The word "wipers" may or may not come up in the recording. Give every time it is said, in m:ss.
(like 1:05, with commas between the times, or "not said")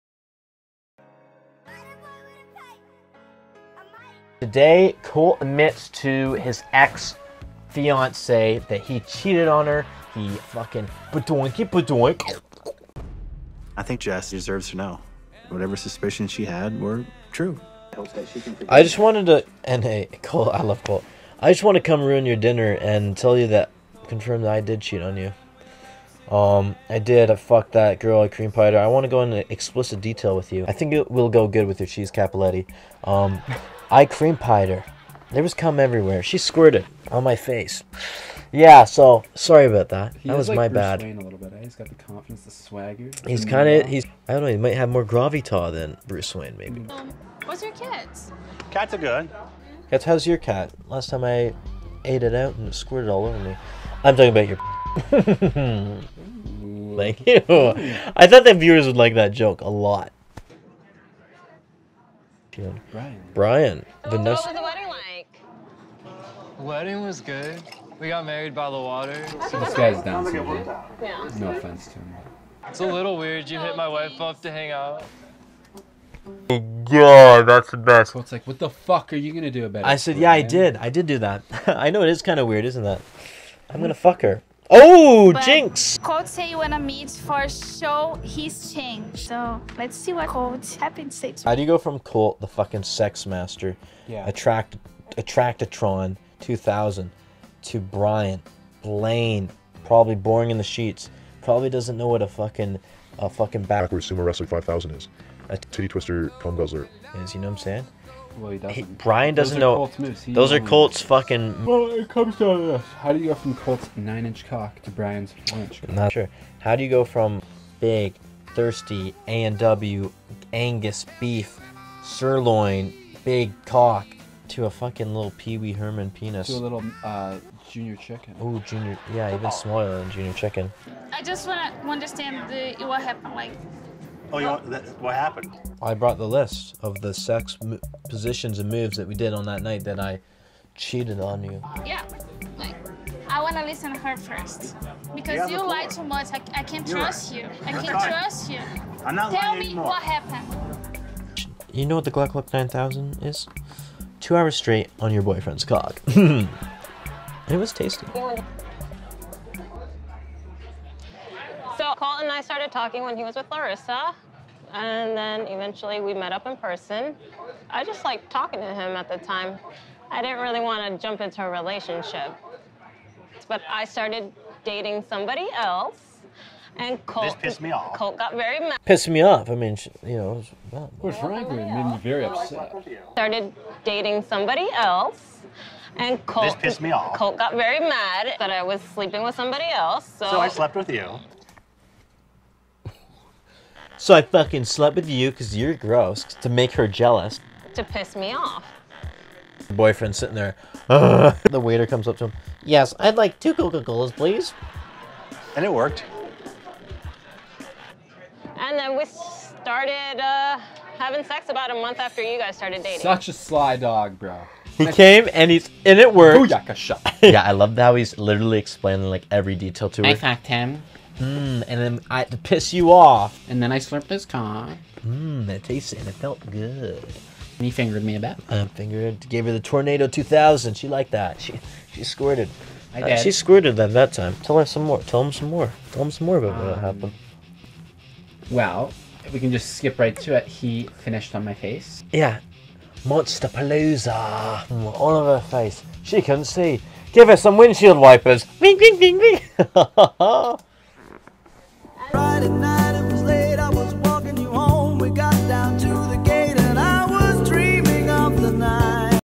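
4:07.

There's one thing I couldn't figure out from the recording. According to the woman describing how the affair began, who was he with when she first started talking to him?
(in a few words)
Larissa.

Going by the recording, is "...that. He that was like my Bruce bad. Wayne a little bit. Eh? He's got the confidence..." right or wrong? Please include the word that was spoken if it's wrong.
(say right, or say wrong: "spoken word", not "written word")
right.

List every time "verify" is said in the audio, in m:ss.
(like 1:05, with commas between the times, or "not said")
not said.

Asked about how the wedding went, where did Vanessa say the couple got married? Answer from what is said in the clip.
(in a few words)
by the water.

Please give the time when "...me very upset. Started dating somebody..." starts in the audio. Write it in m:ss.
3:01.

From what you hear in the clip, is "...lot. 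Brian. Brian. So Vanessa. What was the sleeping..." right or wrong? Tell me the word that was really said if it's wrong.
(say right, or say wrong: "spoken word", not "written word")
wrong: "wedding", not "sleeping".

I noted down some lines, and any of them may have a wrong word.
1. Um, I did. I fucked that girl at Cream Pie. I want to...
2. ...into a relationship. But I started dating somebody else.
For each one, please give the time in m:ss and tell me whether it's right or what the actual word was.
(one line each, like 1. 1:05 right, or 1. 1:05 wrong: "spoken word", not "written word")
1. 0:26 right
2. 2:51 right.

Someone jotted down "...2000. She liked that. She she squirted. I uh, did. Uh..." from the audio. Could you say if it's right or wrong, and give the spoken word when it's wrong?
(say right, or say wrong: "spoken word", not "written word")
right.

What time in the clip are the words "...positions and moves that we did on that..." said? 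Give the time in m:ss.
2:18.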